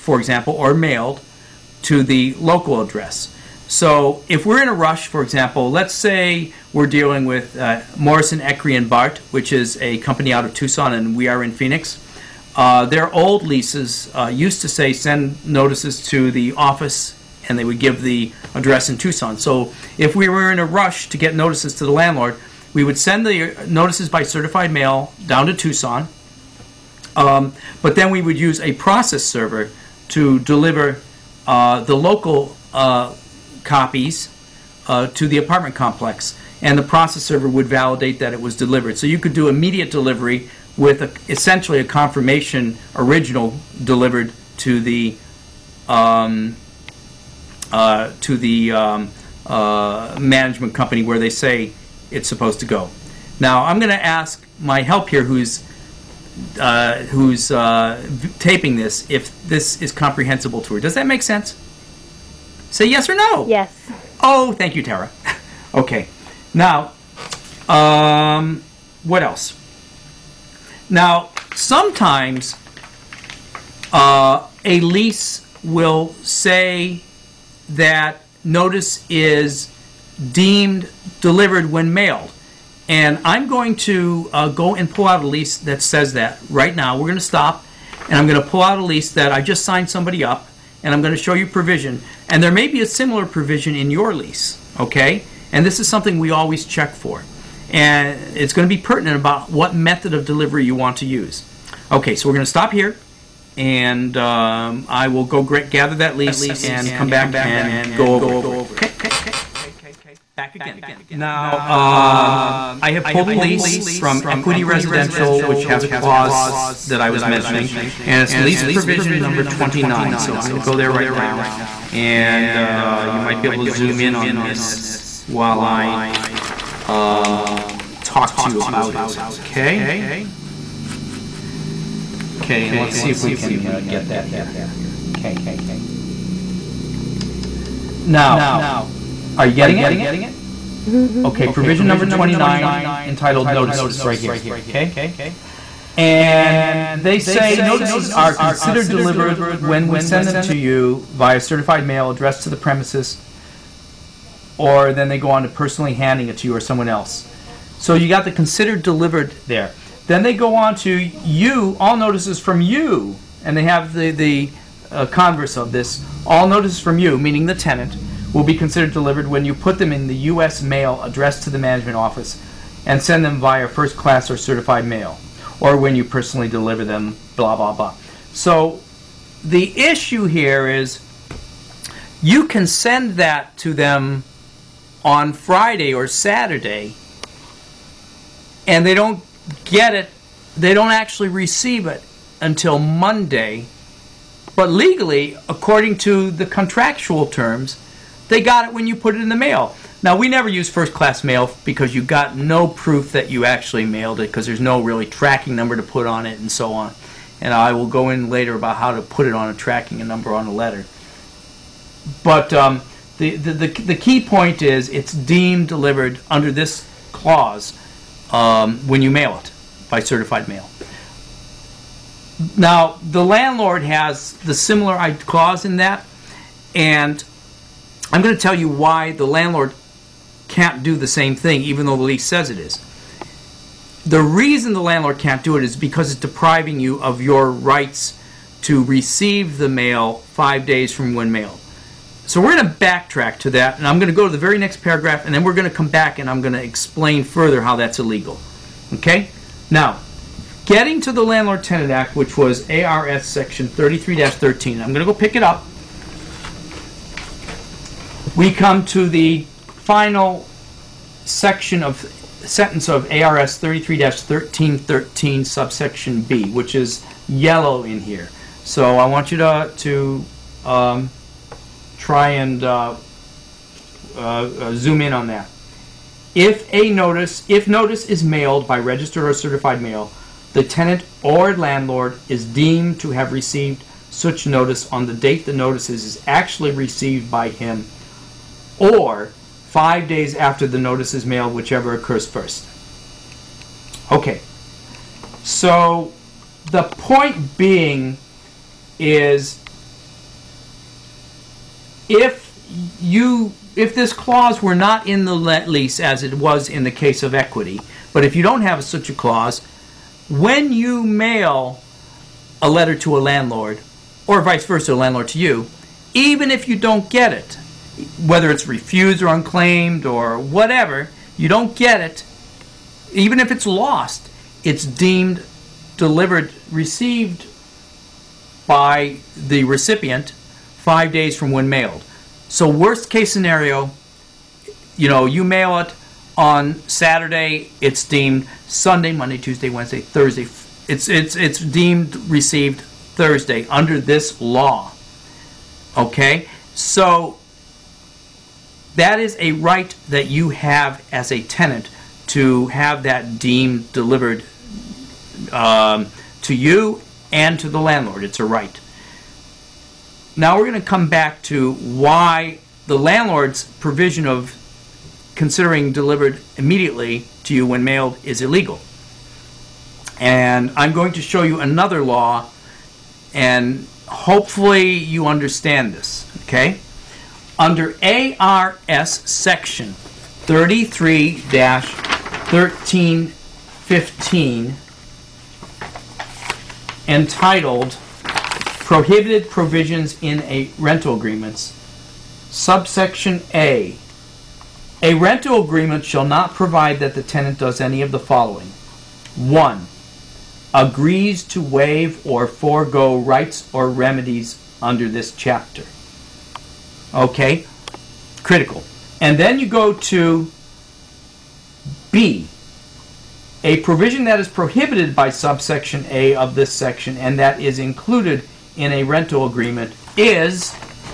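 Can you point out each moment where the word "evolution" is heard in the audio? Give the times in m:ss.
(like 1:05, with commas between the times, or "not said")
not said.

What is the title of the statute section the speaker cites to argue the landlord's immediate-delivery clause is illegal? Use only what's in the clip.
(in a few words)
Prohibited Provisions in a Rental Agreements.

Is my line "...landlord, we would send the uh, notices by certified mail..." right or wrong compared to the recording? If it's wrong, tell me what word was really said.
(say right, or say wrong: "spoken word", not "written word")
right.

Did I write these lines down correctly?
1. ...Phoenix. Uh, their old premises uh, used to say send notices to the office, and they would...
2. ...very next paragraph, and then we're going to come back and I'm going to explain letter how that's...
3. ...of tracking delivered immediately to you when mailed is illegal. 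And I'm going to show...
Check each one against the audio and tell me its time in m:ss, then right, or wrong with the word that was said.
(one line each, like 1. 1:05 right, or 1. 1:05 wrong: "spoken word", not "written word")
1. 0:11 wrong: "leases", not "premises"
2. 4:04 wrong: "further", not "letter"
3. 6:04 wrong: "considering", not "tracking".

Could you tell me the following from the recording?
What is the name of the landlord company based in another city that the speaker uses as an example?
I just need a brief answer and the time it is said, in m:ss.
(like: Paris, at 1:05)
Morrison, Eckery and Bart, at 0:07.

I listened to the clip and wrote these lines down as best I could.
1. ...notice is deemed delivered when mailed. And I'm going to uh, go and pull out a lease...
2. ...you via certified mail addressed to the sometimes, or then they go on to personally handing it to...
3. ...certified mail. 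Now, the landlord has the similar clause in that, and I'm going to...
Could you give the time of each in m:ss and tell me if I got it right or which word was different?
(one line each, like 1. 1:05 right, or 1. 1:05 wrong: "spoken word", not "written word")
1. 1:18 right
2. 2:30 wrong: "premises", not "sometimes"
3. 3:39 right.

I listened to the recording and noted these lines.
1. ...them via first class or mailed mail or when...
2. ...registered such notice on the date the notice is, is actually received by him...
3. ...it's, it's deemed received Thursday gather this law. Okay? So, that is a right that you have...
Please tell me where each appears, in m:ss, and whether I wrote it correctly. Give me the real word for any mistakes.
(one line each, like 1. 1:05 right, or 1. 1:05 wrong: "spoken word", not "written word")
1. 2:53 wrong: "certified", not "mailed"
2. 4:43 wrong: "received", not "registered"
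3. 5:41 wrong: "under", not "gather".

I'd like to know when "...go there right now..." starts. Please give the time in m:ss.
2:00.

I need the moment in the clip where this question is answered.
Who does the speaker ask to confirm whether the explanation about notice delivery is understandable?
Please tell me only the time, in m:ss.
1:04.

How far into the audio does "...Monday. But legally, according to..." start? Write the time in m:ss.
3:12.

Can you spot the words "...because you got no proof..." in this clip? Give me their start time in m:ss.
3:21.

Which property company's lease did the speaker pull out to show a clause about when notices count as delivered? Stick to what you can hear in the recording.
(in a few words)
Equity Residential.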